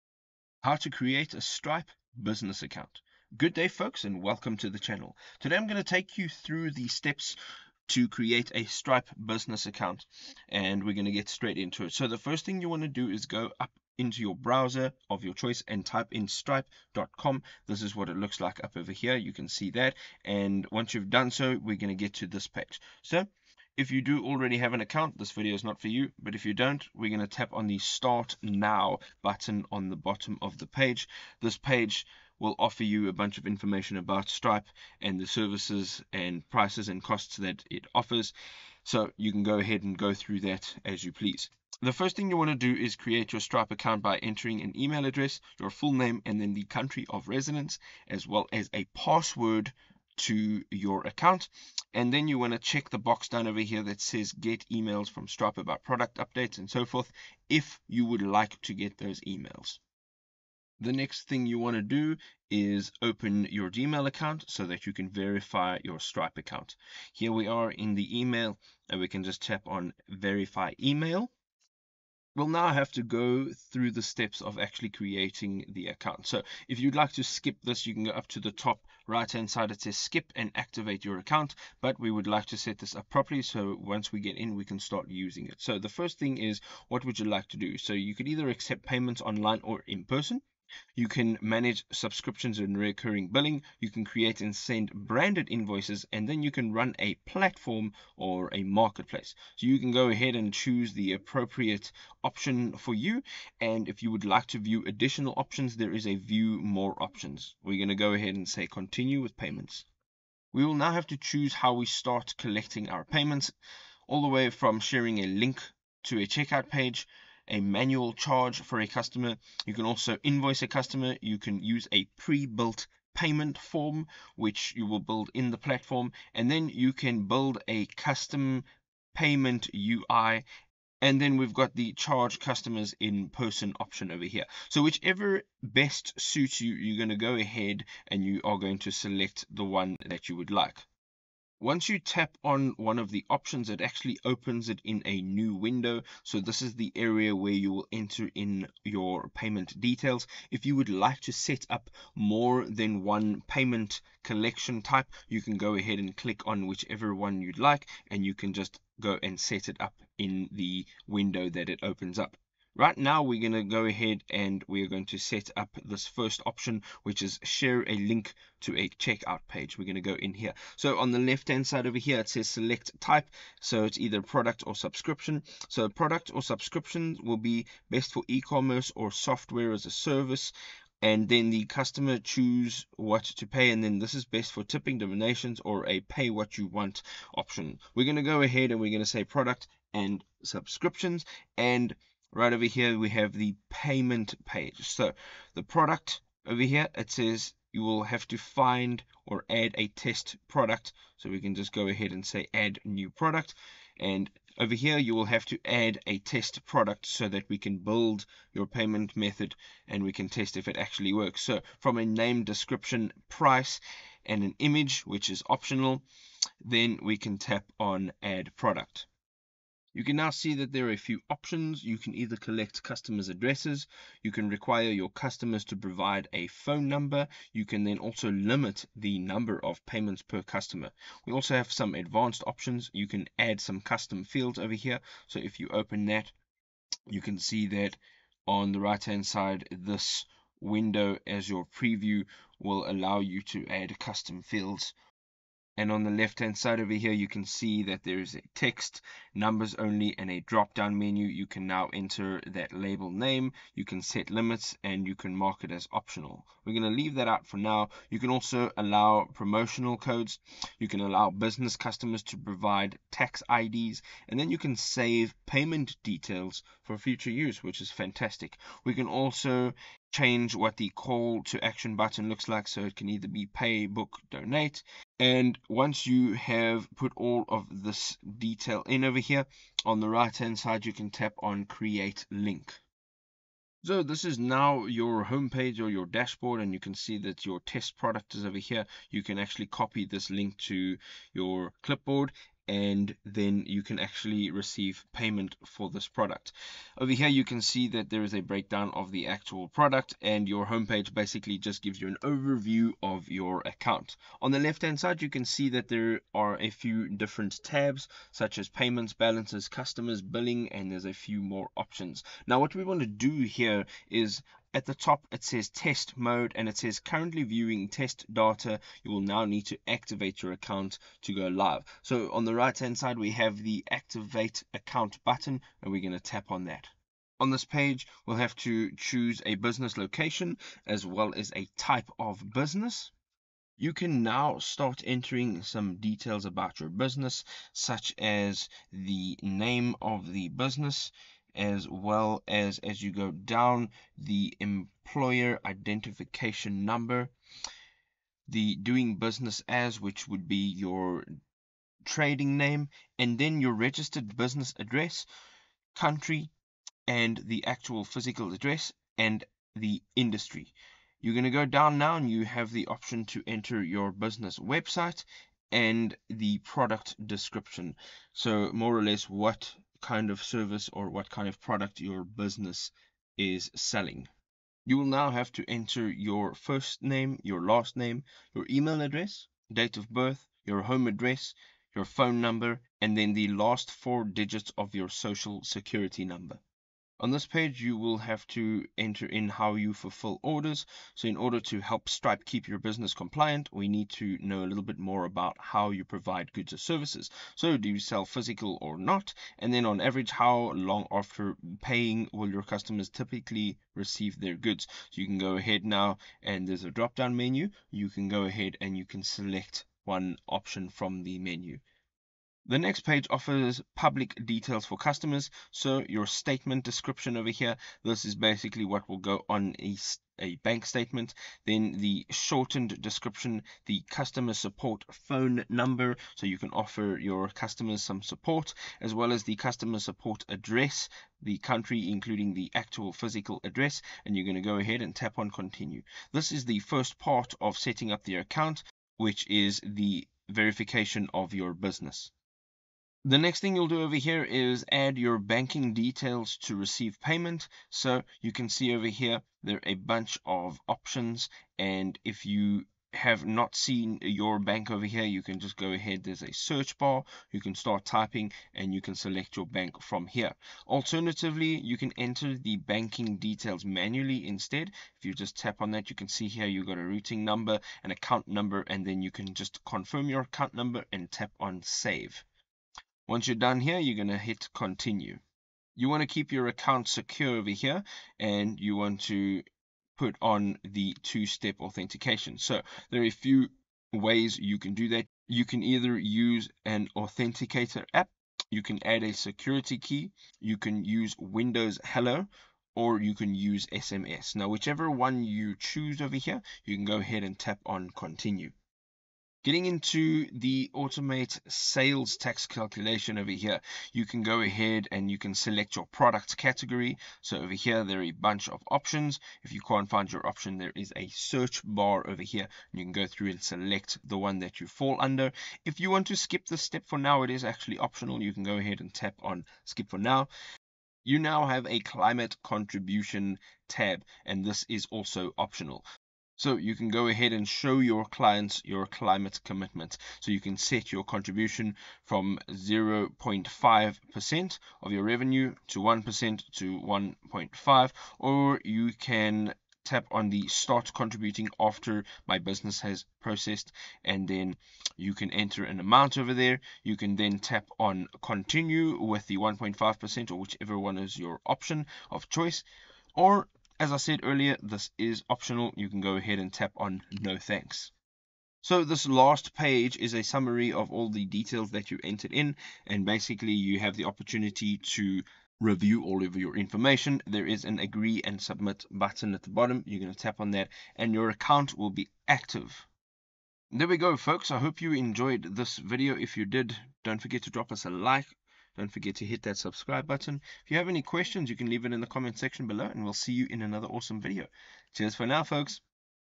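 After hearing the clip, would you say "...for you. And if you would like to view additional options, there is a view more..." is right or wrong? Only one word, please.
right.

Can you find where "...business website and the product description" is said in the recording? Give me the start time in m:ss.
6:04.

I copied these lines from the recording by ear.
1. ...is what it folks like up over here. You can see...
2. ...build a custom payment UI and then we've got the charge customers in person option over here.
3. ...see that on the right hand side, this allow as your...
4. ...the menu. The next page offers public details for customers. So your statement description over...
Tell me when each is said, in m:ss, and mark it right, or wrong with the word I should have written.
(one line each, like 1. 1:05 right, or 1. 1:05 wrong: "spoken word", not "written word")
1. 0:17 wrong: "looks", not "folks"
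2. 2:07 right
3. 3:57 wrong: "window", not "allow"
4. 6:51 right.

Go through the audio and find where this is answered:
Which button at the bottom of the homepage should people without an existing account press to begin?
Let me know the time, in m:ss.
0:27.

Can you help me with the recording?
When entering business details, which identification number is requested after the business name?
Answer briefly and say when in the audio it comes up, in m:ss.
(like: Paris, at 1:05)
employer identification number, at 5:44.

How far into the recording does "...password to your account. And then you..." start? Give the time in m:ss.
0:48.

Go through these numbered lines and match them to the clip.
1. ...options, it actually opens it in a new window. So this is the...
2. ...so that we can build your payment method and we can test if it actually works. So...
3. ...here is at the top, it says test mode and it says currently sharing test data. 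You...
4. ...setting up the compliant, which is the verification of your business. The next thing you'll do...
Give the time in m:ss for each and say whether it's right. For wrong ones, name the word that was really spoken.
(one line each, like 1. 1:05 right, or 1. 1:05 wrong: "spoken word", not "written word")
1. 2:23 right
2. 3:27 right
3. 5:13 wrong: "viewing", not "sharing"
4. 7:17 wrong: "account", not "compliant".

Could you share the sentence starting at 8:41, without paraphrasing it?
You now have a climate contribution tab, and this is also optional.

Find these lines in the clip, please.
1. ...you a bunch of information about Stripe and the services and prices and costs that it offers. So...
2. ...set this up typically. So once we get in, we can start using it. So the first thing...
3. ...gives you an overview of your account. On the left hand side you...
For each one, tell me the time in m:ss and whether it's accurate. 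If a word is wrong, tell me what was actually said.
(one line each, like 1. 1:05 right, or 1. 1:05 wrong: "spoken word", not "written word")
1. 0:32 right
2. 1:22 wrong: "properly", not "typically"
3. 5:01 right.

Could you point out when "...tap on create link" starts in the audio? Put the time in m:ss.
4:41.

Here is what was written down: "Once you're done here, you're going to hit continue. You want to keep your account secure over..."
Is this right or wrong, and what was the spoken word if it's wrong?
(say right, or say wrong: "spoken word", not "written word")
right.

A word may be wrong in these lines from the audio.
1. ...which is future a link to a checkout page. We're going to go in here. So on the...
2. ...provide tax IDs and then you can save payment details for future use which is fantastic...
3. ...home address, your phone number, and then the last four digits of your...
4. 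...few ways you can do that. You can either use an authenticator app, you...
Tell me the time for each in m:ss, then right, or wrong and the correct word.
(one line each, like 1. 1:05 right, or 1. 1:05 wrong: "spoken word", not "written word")
1. 2:47 wrong: "share", not "future"
2. 4:22 right
3. 6:20 right
4. 8:03 right.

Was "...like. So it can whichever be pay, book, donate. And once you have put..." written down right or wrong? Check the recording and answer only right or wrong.
wrong.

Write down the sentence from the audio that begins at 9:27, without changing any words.
There is an agree and submit button at the bottom.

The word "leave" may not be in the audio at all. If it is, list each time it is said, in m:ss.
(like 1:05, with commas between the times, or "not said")
4:17, 9:41.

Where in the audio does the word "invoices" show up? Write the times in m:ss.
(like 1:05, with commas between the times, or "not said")
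1:35, 2:00.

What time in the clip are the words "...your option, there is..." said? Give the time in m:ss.
8:30.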